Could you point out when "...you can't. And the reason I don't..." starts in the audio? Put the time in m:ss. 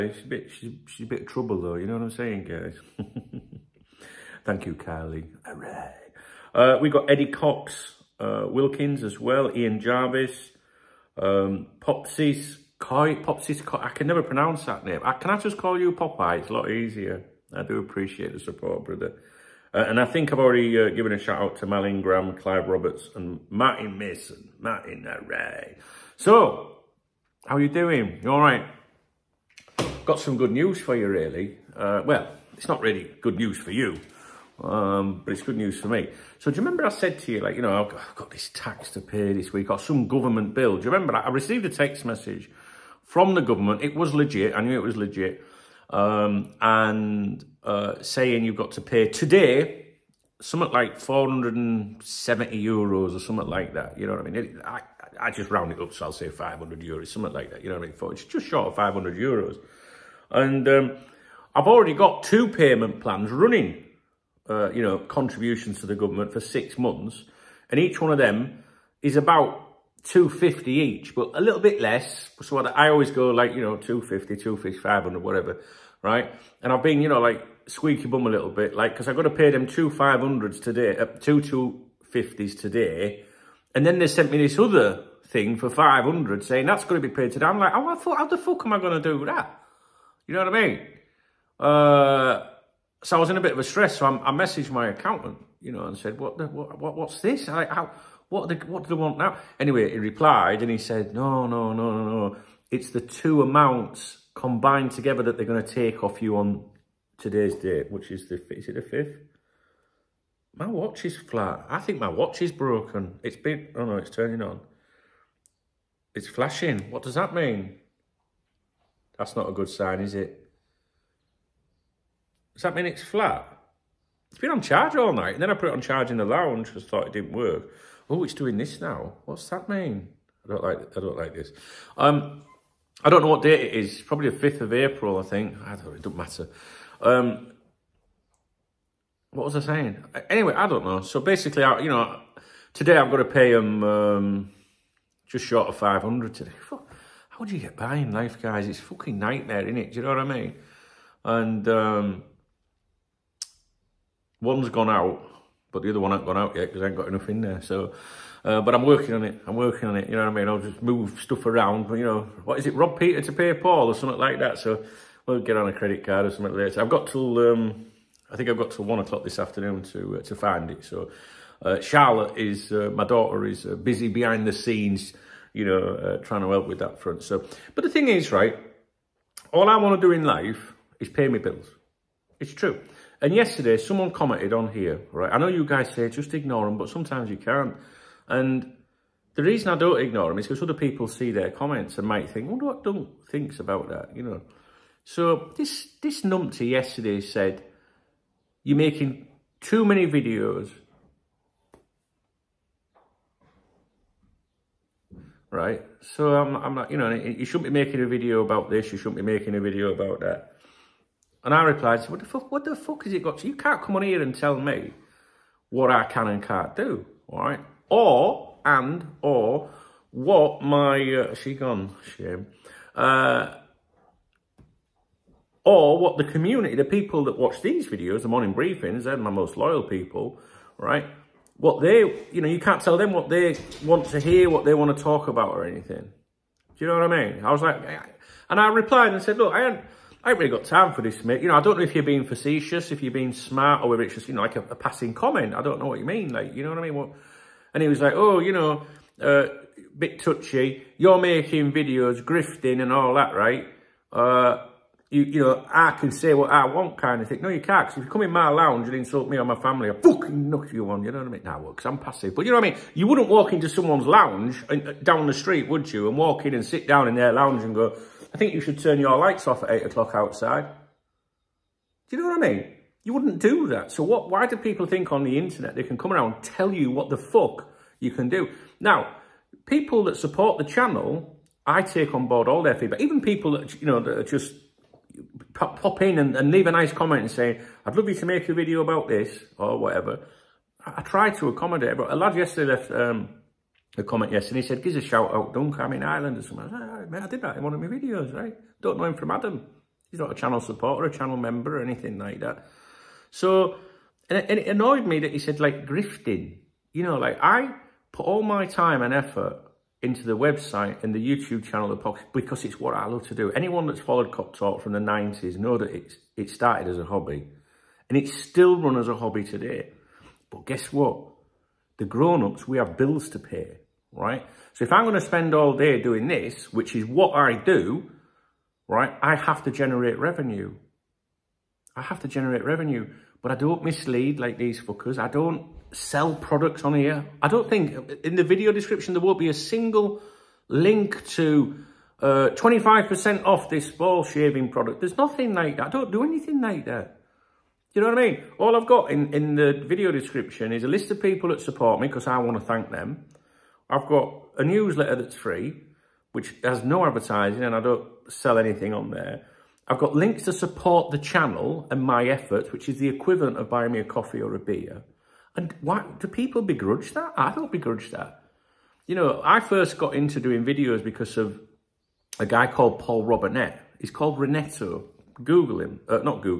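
3:07.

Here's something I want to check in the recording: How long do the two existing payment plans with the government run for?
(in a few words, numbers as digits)
six months.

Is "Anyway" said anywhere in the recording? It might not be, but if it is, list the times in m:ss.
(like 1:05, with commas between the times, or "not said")
1:39, 2:20.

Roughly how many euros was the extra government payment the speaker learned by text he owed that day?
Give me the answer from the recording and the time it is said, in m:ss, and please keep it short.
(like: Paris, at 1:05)
470 euros, at 0:50.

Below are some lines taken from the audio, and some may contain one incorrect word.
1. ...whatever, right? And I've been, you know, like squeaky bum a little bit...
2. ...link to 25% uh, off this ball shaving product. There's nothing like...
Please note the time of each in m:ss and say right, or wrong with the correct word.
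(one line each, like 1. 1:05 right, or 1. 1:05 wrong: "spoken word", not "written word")
1. 1:15 right
2. 5:40 right.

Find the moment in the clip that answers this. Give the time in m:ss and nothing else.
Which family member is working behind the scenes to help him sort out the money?
2:51.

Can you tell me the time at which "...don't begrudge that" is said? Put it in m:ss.
6:07.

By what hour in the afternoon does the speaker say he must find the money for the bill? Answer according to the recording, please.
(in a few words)
one o'clock.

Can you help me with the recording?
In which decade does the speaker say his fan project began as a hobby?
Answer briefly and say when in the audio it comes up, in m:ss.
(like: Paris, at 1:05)
the 90s, at 5:14.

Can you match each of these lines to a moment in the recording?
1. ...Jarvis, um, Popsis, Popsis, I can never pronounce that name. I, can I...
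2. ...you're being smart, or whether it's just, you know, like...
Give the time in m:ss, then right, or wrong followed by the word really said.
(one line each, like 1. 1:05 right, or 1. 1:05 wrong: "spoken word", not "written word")
1. 0:09 right
2. 4:03 right.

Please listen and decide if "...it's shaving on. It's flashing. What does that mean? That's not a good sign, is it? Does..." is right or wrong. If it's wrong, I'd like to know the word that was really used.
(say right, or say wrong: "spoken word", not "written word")
wrong: "turning", not "shaving".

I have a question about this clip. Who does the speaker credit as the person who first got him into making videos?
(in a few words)
Paul Robinett.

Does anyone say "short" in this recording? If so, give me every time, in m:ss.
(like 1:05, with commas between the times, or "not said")
0:58, 2:25.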